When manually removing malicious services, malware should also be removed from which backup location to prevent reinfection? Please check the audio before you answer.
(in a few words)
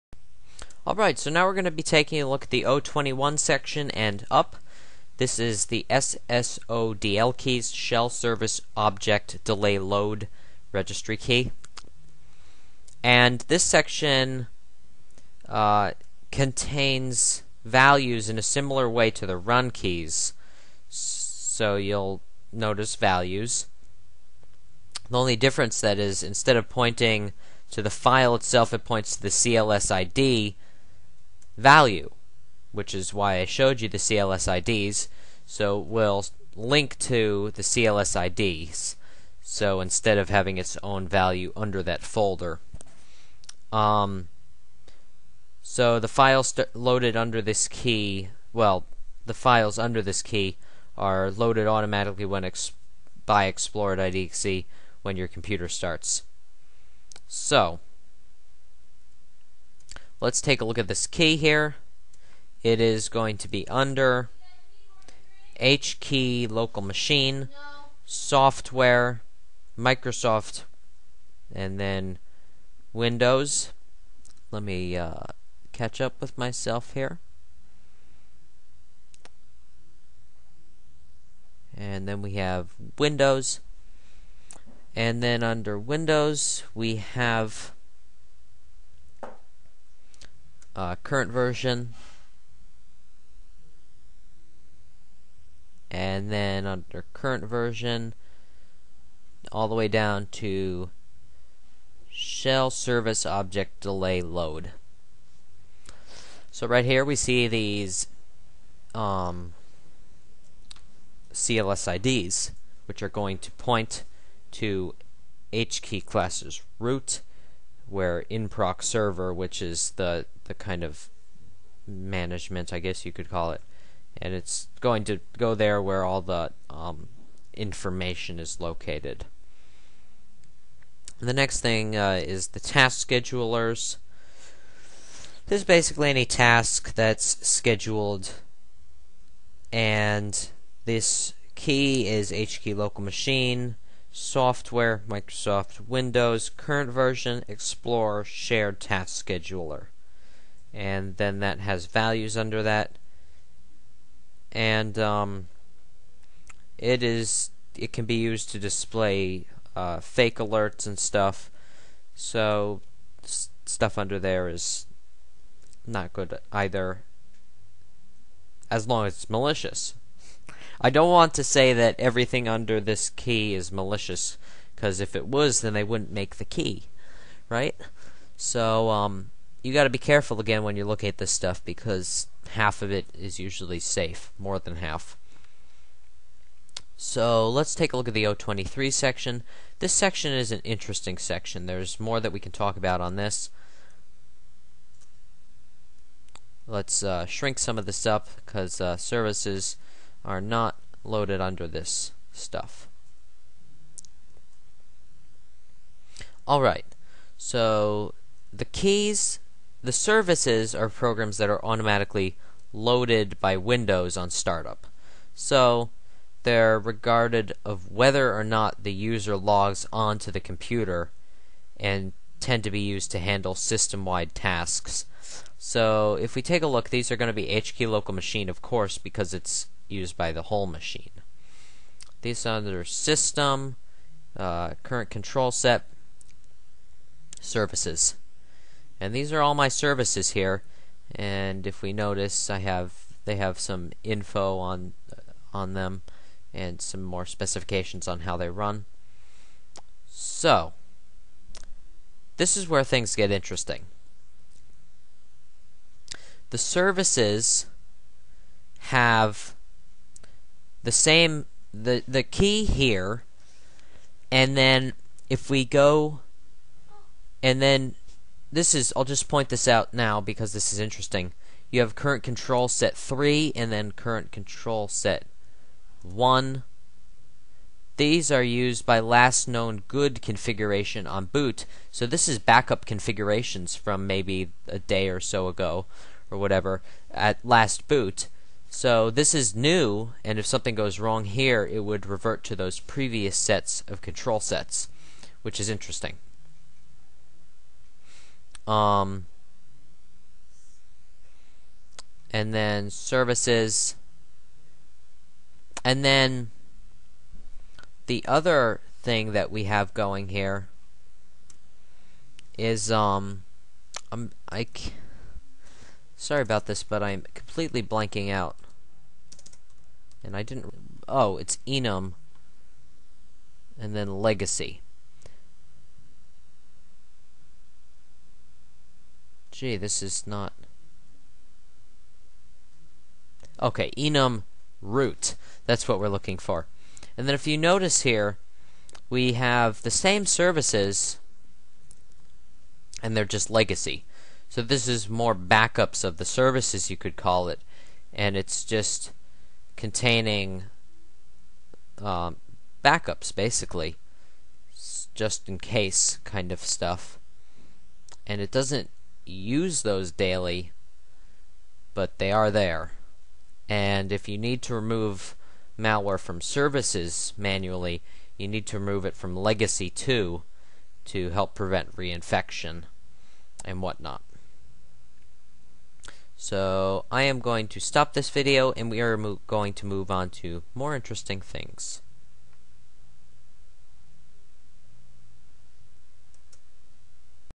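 legacy 2.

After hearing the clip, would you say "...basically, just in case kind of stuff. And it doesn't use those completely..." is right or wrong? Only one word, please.
wrong.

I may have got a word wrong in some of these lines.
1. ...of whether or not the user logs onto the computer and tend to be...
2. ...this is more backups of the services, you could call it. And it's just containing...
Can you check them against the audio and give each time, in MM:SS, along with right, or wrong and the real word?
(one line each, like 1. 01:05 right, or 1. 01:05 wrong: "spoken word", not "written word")
1. 03:37 right
2. 05:44 right.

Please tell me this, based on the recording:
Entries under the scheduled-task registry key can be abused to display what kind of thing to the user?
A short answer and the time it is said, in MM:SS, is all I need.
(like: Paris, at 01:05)
fake alerts, at 02:40.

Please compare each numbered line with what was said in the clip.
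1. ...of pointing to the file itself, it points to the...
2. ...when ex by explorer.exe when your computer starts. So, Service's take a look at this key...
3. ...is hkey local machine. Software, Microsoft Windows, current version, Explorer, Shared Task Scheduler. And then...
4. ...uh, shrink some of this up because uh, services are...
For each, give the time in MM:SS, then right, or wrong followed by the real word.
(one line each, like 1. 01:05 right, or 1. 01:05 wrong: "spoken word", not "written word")
1. 00:26 right
2. 00:52 wrong: "Let", not "Service"
3. 02:22 right
4. 03:17 right.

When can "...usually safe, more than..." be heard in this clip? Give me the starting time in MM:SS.
03:03.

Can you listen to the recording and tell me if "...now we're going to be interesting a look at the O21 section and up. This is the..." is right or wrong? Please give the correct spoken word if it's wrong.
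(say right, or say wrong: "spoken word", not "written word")
wrong: "taking", not "interesting".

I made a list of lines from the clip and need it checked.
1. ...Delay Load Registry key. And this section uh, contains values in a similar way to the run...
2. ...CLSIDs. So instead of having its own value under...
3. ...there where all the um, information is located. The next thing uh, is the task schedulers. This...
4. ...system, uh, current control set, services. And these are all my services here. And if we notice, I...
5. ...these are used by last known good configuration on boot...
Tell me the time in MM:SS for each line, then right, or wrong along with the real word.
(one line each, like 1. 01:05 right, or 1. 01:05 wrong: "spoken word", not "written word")
1. 00:09 right
2. 00:37 right
3. 02:05 right
4. 03:52 right
5. 04:37 right.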